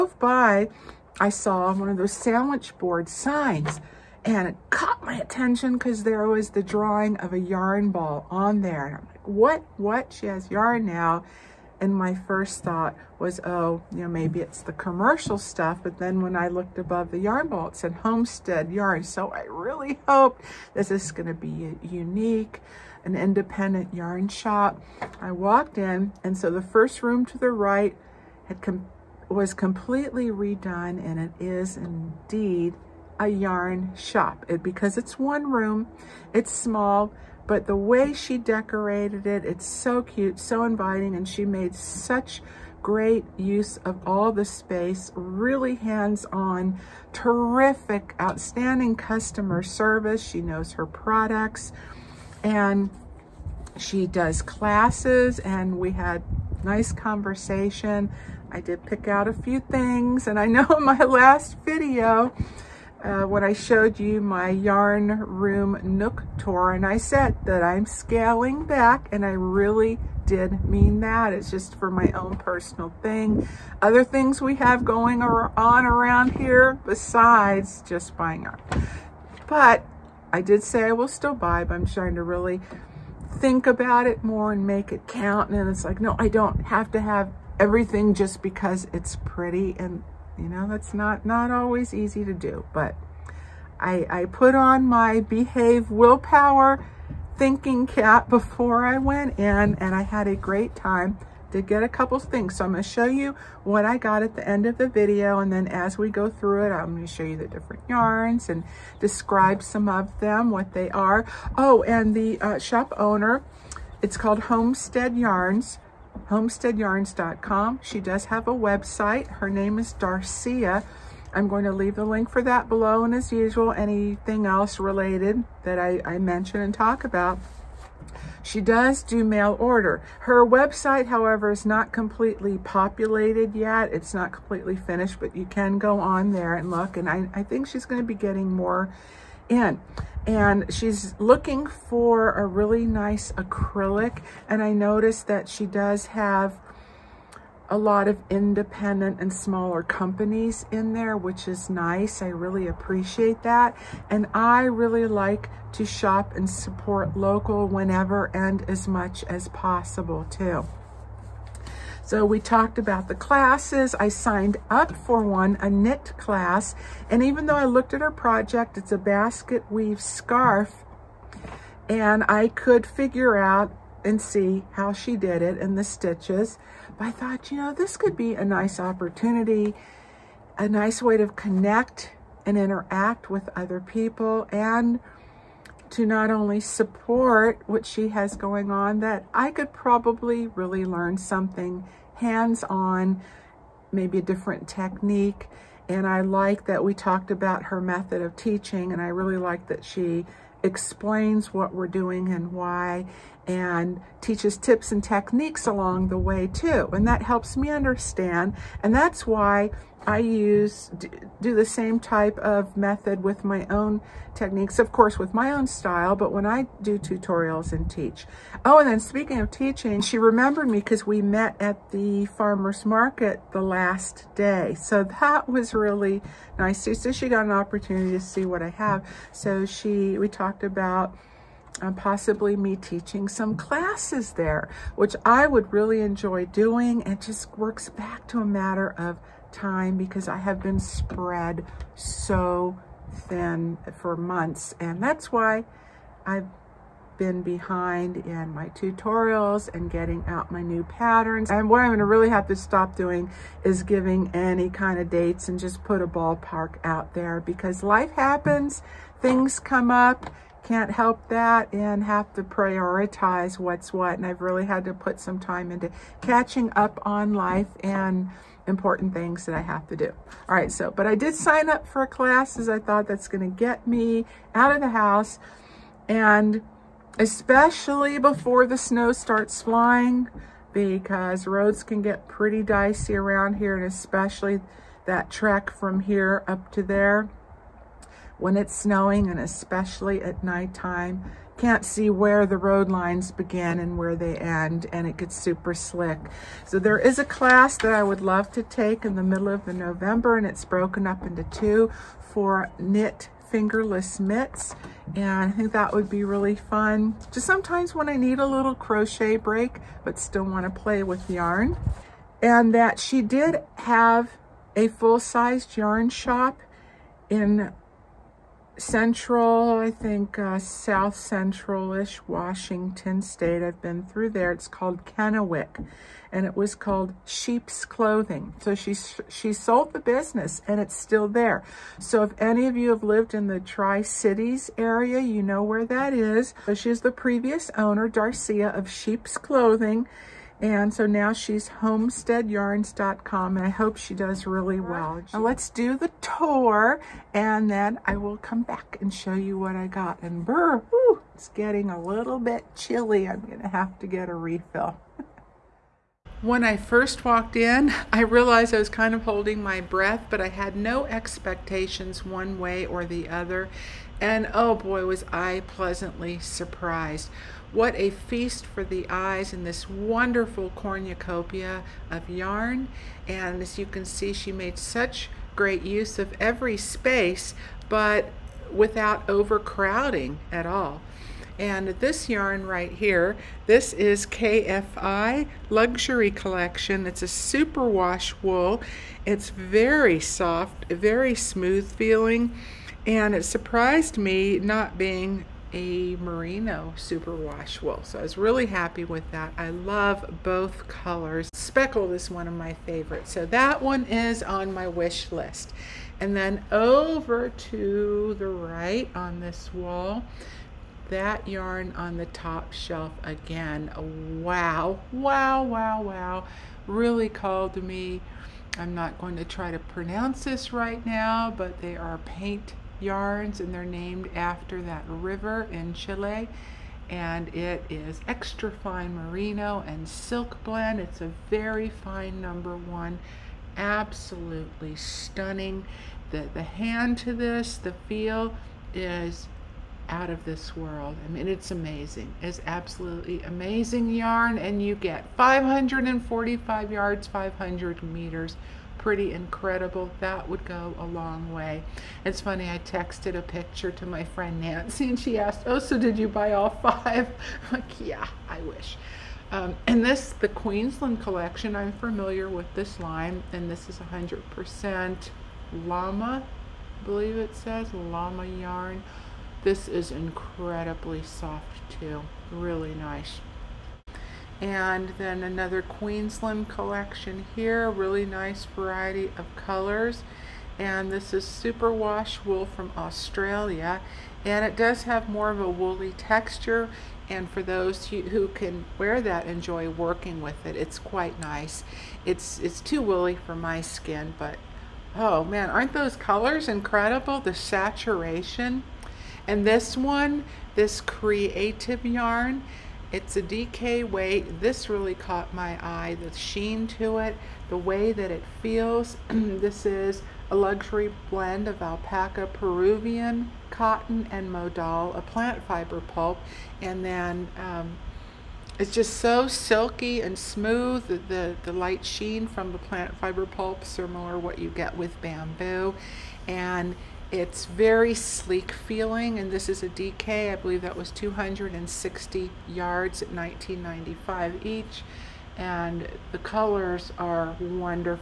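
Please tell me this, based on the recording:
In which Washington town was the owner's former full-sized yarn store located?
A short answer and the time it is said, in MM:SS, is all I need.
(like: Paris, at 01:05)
Kennewick, at 05:25.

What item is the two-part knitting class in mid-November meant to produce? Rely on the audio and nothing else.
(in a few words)
fingerless mitts.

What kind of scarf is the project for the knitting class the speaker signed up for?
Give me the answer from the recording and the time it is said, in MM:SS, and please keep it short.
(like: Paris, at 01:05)
basket weave scarf, at 02:48.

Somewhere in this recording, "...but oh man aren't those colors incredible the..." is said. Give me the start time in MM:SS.
08:14.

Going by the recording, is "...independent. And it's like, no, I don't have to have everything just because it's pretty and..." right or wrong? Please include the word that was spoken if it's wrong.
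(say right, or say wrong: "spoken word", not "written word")
wrong: "count", not "independent".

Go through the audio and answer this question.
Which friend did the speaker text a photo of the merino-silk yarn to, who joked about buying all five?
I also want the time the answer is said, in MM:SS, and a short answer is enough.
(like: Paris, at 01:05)
Nancy, at 07:34.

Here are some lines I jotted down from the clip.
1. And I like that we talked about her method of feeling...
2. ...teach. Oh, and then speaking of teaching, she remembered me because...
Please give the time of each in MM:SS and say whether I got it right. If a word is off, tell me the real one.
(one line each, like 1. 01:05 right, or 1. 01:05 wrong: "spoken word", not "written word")
1. 03:15 wrong: "teaching", not "feeling"
2. 03:37 right.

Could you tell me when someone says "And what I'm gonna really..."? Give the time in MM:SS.
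04:11.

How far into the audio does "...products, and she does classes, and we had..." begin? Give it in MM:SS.
00:50.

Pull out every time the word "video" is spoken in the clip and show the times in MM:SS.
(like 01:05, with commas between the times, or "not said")
01:01, 01:44.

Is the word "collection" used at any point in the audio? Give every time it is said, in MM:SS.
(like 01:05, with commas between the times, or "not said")
06:26, 07:41, 07:56.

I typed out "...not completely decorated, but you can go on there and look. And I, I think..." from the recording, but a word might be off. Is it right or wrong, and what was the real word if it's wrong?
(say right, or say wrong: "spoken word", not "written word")
wrong: "finished", not "decorated".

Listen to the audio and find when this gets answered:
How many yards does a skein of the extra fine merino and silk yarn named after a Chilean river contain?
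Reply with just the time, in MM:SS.
07:25.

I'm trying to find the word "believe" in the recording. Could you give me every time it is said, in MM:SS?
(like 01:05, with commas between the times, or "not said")
07:47, 08:50.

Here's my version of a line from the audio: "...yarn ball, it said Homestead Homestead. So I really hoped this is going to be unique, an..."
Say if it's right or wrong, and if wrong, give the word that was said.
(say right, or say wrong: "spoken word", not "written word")
wrong: "Yarn", not "Homestead".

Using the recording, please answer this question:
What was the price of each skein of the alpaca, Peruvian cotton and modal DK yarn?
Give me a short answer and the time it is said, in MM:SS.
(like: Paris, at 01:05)
19.95, at 08:53.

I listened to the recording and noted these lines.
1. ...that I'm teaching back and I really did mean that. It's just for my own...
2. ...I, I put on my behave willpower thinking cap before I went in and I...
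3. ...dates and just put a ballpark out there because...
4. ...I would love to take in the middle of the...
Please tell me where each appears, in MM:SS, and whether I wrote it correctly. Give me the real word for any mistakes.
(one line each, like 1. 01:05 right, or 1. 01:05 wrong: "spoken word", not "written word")
1. 01:07 wrong: "scaling", not "teaching"
2. 01:33 right
3. 04:15 right
4. 04:57 right.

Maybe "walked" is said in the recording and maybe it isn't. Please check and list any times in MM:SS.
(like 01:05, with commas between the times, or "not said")
00:25, 05:57.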